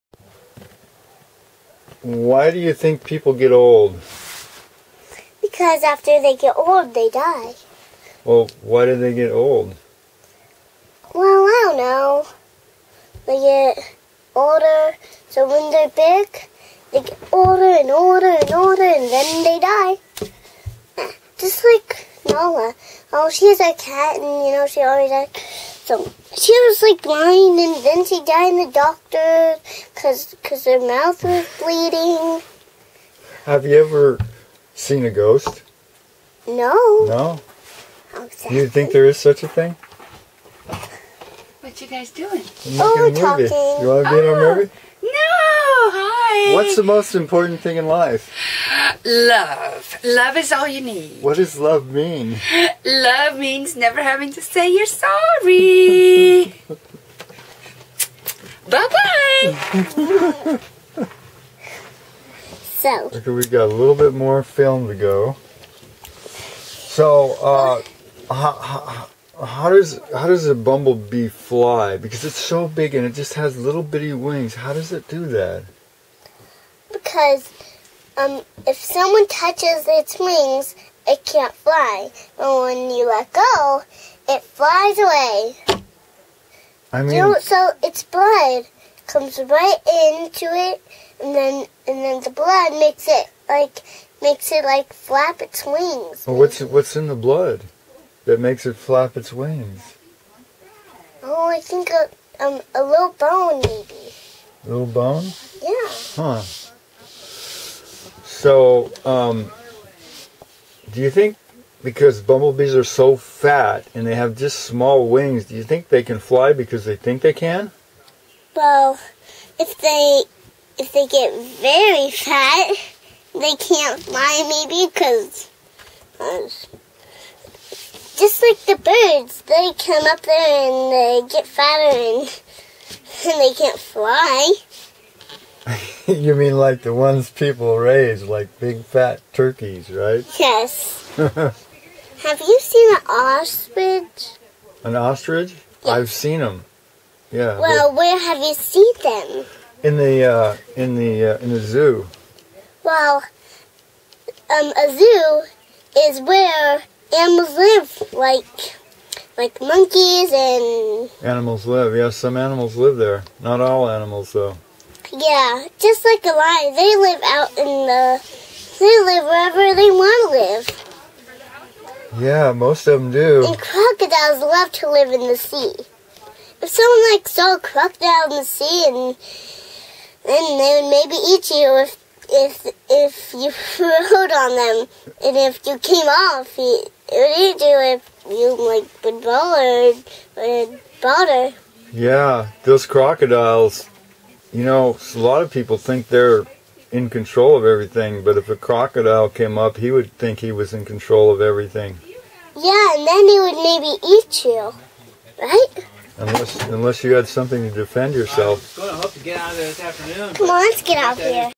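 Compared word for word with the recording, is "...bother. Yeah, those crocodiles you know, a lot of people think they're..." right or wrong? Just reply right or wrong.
right.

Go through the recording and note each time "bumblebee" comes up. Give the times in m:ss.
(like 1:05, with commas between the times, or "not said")
1:10, 1:52.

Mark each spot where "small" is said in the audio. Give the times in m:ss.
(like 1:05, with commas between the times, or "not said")
1:54.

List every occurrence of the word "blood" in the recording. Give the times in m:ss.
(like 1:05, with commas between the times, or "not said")
1:28, 1:32, 1:37.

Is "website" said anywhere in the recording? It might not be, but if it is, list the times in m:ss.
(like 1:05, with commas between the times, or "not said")
not said.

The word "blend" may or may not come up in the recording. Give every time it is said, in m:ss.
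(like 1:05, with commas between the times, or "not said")
not said.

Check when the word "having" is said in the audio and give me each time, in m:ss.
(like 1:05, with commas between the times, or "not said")
0:54.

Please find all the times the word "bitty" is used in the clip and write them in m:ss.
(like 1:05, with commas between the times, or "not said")
1:13.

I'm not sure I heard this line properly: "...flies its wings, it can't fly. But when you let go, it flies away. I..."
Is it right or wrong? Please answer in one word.
wrong.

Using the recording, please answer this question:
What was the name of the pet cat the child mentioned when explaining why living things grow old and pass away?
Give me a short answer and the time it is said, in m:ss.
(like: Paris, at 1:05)
Nala, at 0:22.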